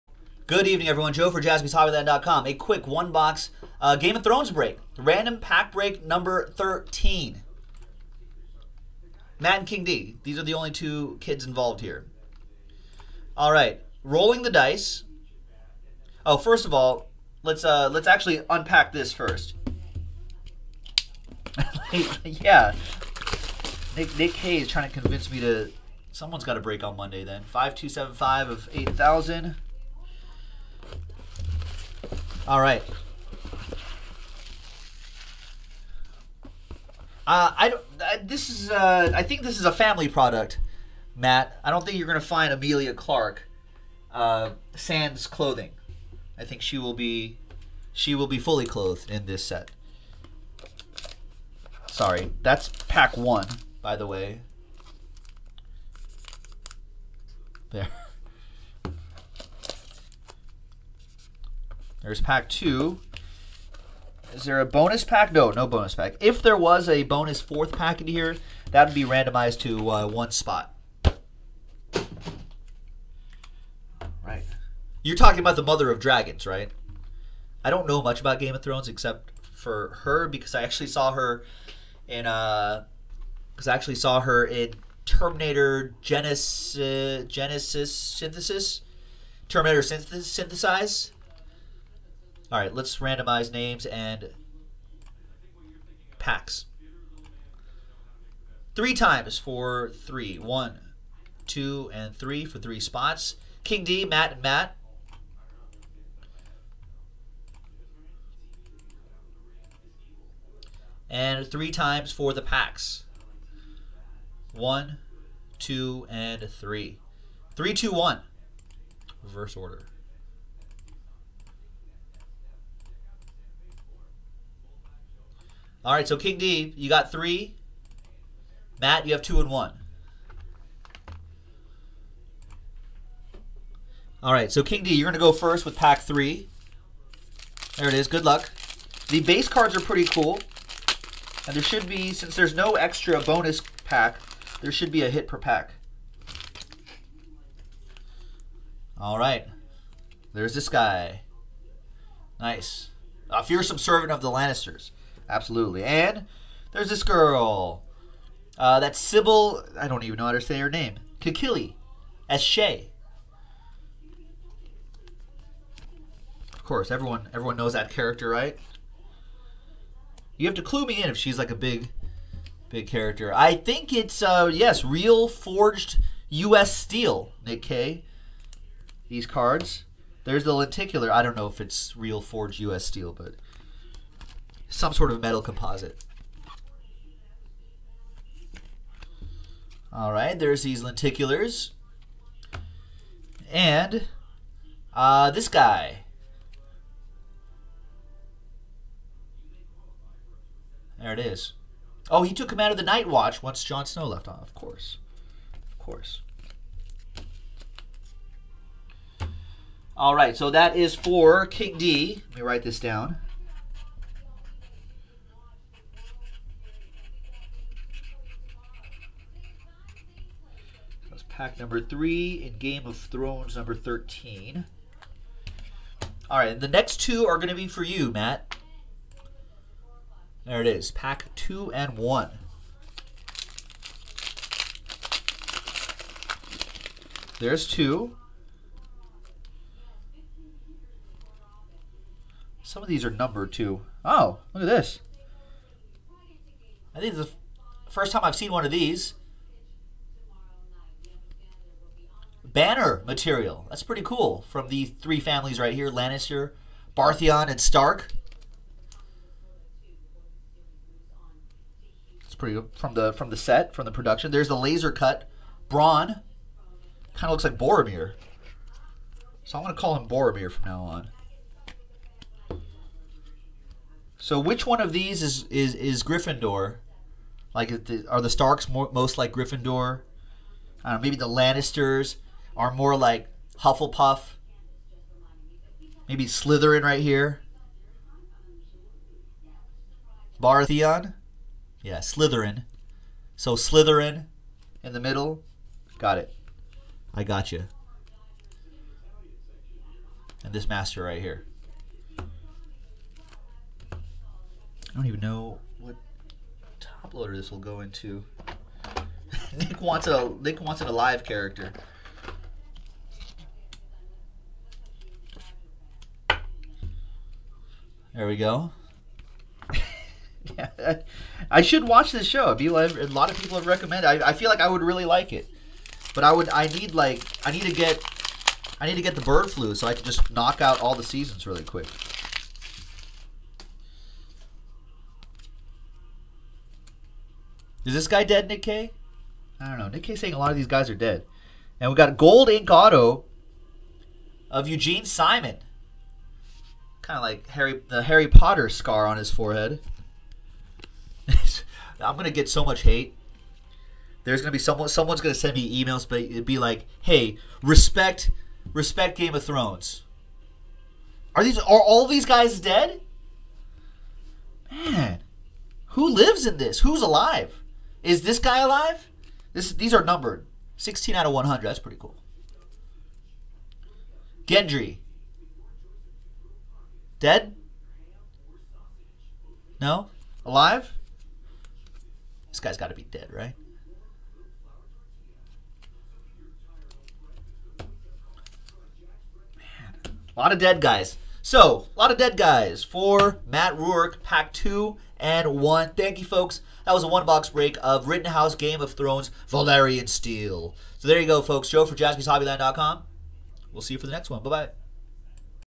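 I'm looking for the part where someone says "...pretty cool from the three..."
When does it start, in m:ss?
4:13.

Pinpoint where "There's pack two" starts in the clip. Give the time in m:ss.
1:02.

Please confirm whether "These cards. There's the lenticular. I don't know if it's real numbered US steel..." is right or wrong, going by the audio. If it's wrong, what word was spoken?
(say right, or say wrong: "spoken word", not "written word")
wrong: "forged", not "numbered".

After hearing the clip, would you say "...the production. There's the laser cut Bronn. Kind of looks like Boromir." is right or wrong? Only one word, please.
right.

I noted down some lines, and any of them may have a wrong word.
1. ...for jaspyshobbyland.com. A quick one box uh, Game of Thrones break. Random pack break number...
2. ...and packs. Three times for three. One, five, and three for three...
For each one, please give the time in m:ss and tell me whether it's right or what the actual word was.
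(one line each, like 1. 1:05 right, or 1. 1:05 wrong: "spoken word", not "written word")
1. 0:01 right
2. 1:33 wrong: "two", not "five".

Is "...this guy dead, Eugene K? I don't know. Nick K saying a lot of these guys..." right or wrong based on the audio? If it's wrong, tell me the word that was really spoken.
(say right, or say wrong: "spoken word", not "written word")
wrong: "Nick", not "Eugene".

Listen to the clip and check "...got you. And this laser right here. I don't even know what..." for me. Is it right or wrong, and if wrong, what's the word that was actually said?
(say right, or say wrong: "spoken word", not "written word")
wrong: "master", not "laser".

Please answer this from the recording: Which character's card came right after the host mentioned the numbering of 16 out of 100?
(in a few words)
Gendry.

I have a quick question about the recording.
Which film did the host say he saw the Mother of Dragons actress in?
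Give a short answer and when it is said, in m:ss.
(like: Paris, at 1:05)
Terminator Genisys, at 1:25.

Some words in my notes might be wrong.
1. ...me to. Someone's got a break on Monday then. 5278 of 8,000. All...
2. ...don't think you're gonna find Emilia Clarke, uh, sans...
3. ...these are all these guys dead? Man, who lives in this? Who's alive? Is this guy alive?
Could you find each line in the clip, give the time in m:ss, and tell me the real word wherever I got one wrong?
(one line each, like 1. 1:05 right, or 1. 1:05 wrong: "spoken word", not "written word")
1. 0:25 wrong: "5275", not "5278"
2. 0:41 right
3. 6:01 right.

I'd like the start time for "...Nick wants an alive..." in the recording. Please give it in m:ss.
5:10.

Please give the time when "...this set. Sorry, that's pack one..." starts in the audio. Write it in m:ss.
0:49.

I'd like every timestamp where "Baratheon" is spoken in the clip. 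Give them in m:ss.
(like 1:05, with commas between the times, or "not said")
4:16, 4:50.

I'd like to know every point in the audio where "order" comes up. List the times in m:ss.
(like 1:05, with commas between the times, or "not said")
1:59.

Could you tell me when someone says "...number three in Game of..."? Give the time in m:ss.
3:41.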